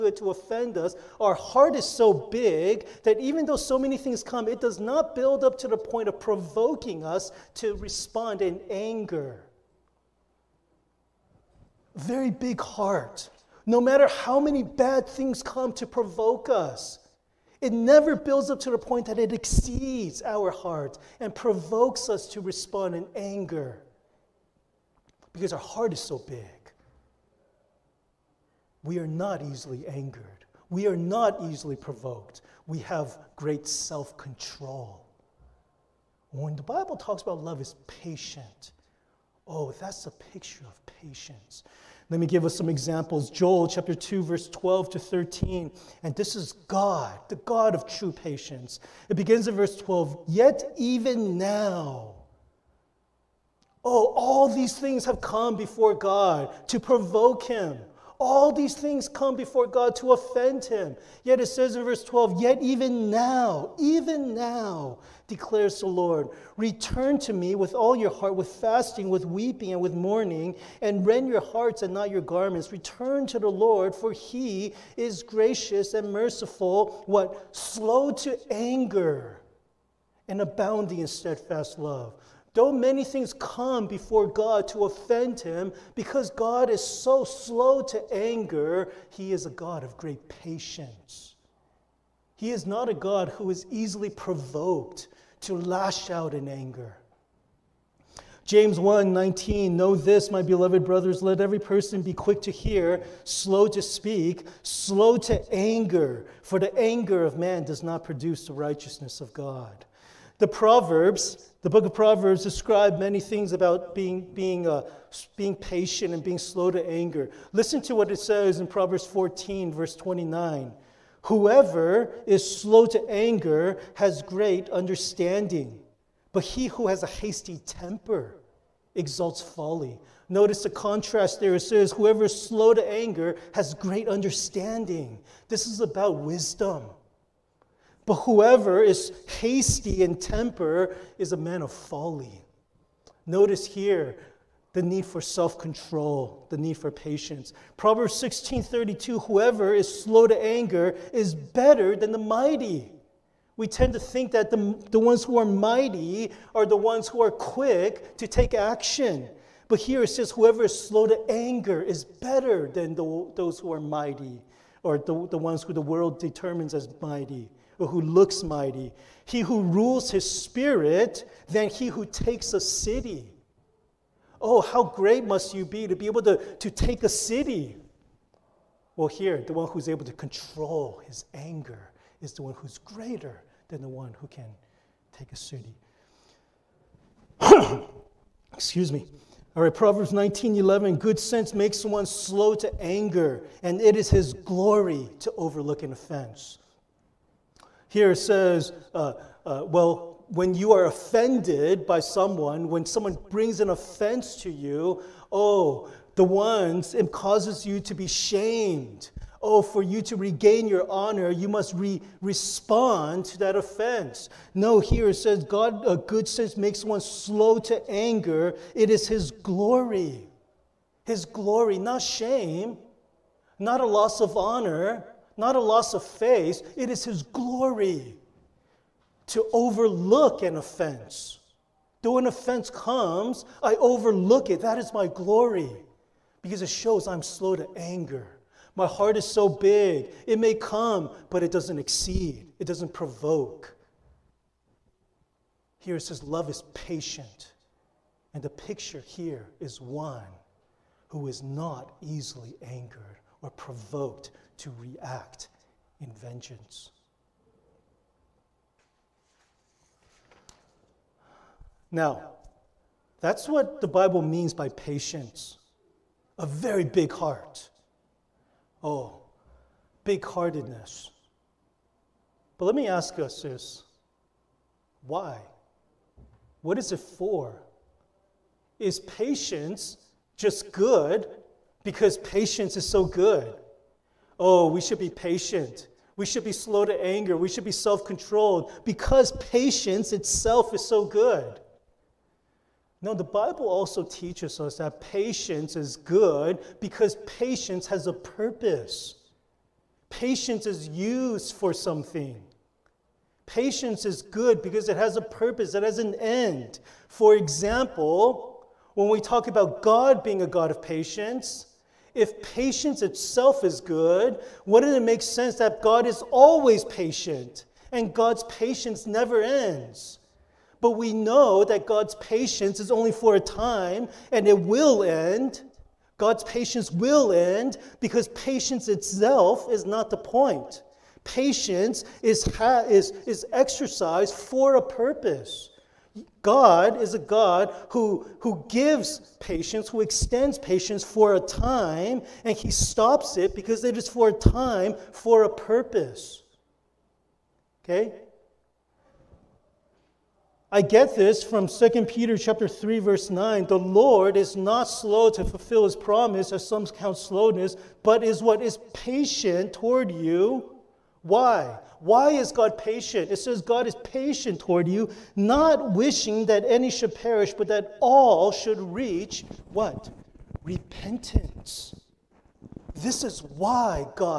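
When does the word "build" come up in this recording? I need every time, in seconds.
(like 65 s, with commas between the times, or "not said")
5 s, 18 s.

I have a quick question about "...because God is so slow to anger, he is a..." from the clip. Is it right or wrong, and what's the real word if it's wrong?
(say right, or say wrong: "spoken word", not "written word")
right.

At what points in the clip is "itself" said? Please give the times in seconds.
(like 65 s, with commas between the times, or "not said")
290 s, 313 s, 328 s.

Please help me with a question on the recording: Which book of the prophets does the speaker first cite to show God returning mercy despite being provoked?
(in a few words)
Joel.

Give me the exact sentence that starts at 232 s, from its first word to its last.
Though an offense comes, I overlook it.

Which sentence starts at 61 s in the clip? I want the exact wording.
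Yet it says in verse 12, Yet even now, even now, declares the Lord.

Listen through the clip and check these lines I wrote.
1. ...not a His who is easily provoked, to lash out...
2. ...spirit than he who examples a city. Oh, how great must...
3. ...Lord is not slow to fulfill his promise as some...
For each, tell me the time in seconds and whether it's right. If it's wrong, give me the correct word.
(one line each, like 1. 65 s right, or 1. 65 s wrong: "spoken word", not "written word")
1. 92 s wrong: "God", not "His"
2. 170 s wrong: "takes", not "examples"
3. 353 s right.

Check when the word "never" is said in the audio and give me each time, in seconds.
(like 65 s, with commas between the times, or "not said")
17 s, 319 s.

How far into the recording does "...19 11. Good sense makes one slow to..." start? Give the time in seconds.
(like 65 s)
190 s.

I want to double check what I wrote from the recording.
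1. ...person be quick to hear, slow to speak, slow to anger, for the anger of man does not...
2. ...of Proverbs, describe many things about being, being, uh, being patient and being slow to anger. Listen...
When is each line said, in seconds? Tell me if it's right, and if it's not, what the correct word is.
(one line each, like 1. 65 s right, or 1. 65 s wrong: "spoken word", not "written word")
1. 101 s right
2. 111 s right.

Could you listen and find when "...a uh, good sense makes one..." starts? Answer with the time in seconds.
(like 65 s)
215 s.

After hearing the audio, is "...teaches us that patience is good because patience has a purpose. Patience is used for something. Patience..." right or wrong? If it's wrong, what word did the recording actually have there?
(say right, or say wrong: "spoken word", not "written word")
right.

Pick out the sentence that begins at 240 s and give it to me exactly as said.
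It may come, but it doesn't exceed, it doesn't provoke.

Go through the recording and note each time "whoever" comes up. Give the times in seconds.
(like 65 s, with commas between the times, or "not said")
121 s, 131 s, 138 s, 149 s, 160 s.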